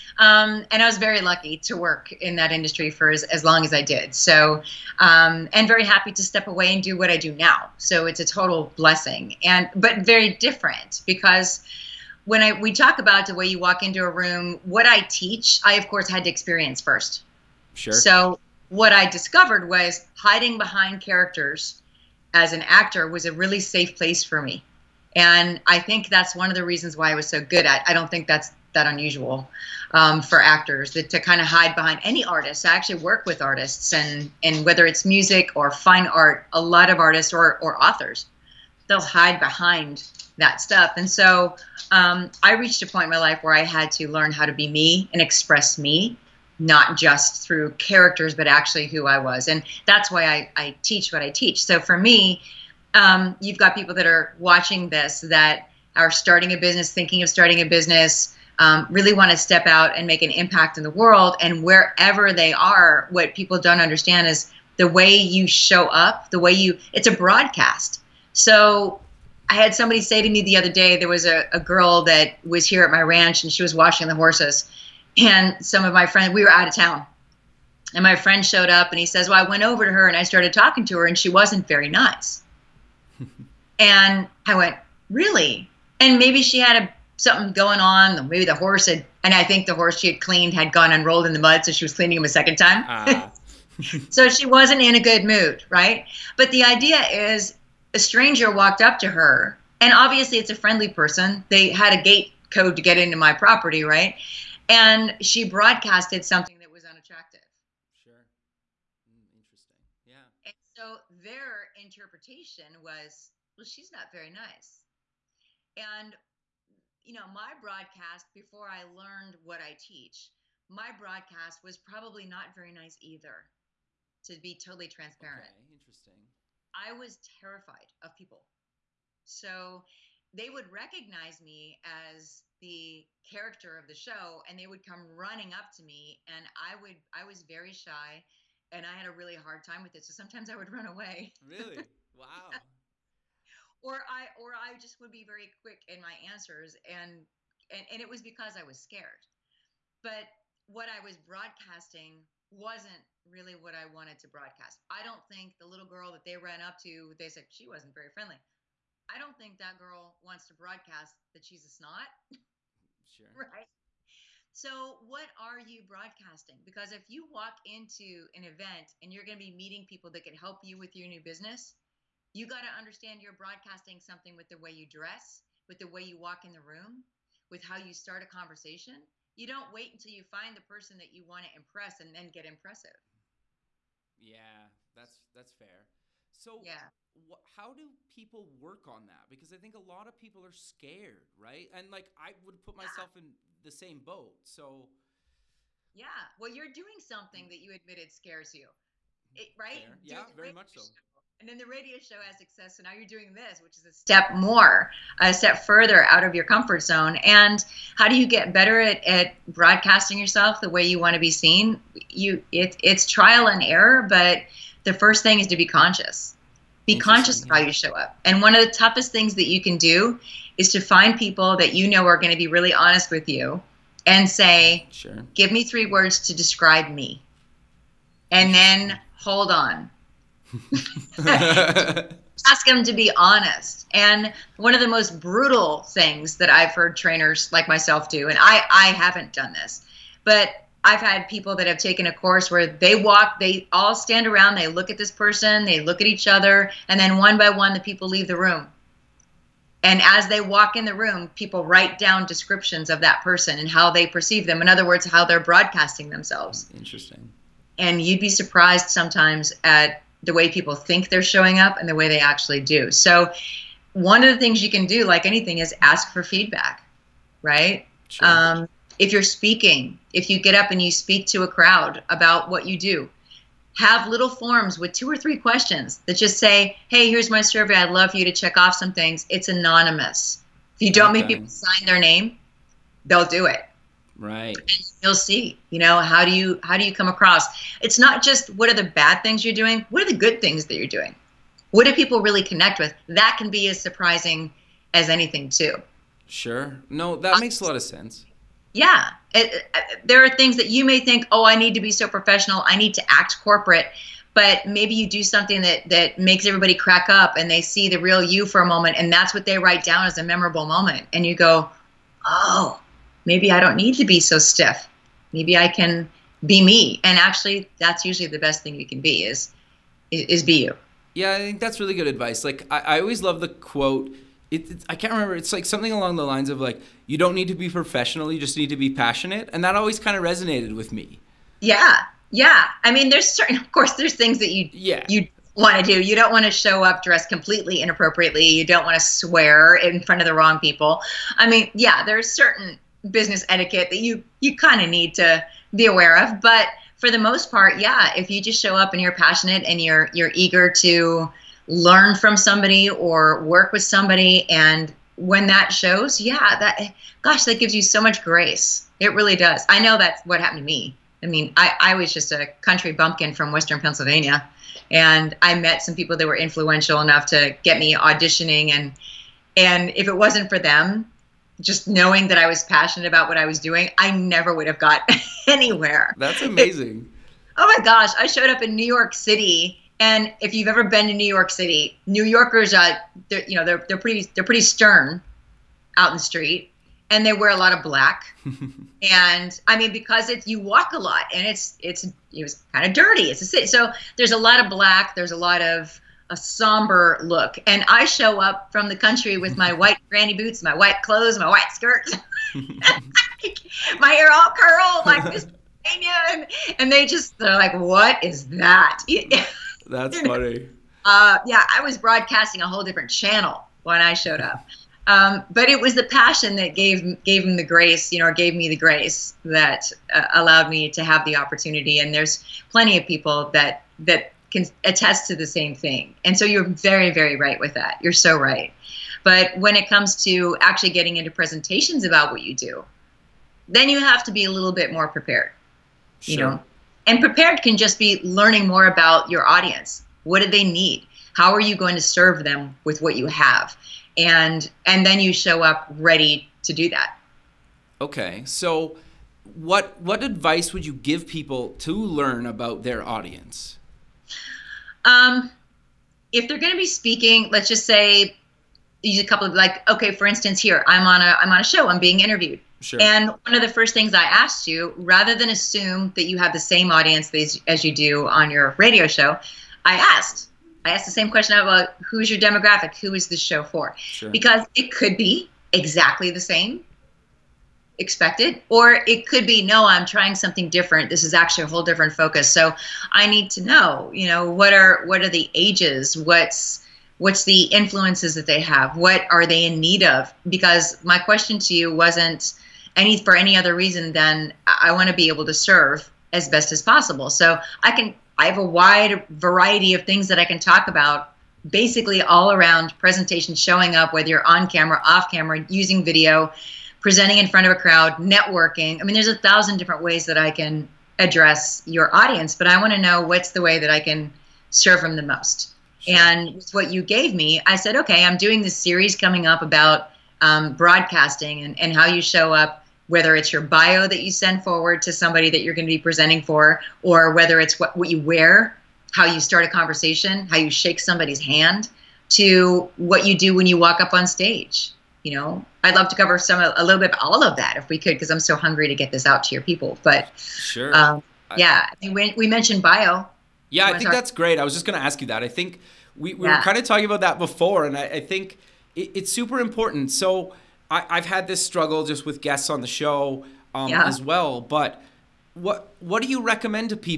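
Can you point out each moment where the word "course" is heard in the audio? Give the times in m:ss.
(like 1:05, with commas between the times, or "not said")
0:15, 4:02, 5:33.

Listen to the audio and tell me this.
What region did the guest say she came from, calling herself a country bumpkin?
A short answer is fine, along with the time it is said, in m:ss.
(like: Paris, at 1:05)
western Pennsylvania, at 6:03.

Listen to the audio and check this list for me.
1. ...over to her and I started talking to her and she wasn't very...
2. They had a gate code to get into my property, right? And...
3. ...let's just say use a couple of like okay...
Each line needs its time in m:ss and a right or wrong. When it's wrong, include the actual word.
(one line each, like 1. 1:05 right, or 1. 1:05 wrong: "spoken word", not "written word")
1. 1:19 right
2. 1:41 right
3. 7:37 right.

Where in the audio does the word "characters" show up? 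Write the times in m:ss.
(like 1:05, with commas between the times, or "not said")
0:21, 0:47, 2:13.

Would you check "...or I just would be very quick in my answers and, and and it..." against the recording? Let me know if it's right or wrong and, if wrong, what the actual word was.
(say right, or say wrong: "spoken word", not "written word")
right.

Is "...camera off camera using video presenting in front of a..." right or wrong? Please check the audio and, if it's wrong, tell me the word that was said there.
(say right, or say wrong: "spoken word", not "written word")
right.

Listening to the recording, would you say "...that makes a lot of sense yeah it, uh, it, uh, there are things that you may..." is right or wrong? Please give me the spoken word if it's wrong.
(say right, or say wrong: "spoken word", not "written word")
right.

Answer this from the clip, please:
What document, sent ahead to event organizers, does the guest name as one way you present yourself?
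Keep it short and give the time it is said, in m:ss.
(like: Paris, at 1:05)
your bio, at 8:43.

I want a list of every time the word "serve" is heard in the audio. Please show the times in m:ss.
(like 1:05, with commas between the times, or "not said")
7:22, 8:15, 8:34.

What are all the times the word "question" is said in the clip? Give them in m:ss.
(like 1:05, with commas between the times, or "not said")
4:35, 7:51, 8:11.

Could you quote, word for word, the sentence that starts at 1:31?
So she was cleaning him a second time.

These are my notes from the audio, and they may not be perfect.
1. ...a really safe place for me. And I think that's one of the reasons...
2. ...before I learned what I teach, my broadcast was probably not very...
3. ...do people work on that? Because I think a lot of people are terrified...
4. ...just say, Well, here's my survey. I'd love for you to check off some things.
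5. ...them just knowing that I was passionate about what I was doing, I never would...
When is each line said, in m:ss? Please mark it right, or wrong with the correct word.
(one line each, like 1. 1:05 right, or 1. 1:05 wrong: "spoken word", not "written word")
1. 0:23 right
2. 1:58 right
3. 3:07 wrong: "scared", not "terrified"
4. 4:36 wrong: "Hey", not "Well"
5. 6:10 right.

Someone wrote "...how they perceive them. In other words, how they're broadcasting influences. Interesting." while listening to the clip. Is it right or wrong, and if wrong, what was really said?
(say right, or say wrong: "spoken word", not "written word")
wrong: "themselves", not "influences".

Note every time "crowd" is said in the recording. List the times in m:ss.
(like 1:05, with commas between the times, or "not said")
4:31, 8:27.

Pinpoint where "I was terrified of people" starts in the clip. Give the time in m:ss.
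2:06.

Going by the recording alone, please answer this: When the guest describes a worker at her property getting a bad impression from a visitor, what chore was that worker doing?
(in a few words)
washing the horses.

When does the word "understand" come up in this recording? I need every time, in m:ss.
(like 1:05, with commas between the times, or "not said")
1:03, 2:52.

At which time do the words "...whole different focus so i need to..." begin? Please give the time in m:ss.
8:01.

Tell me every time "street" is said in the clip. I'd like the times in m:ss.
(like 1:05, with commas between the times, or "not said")
6:26.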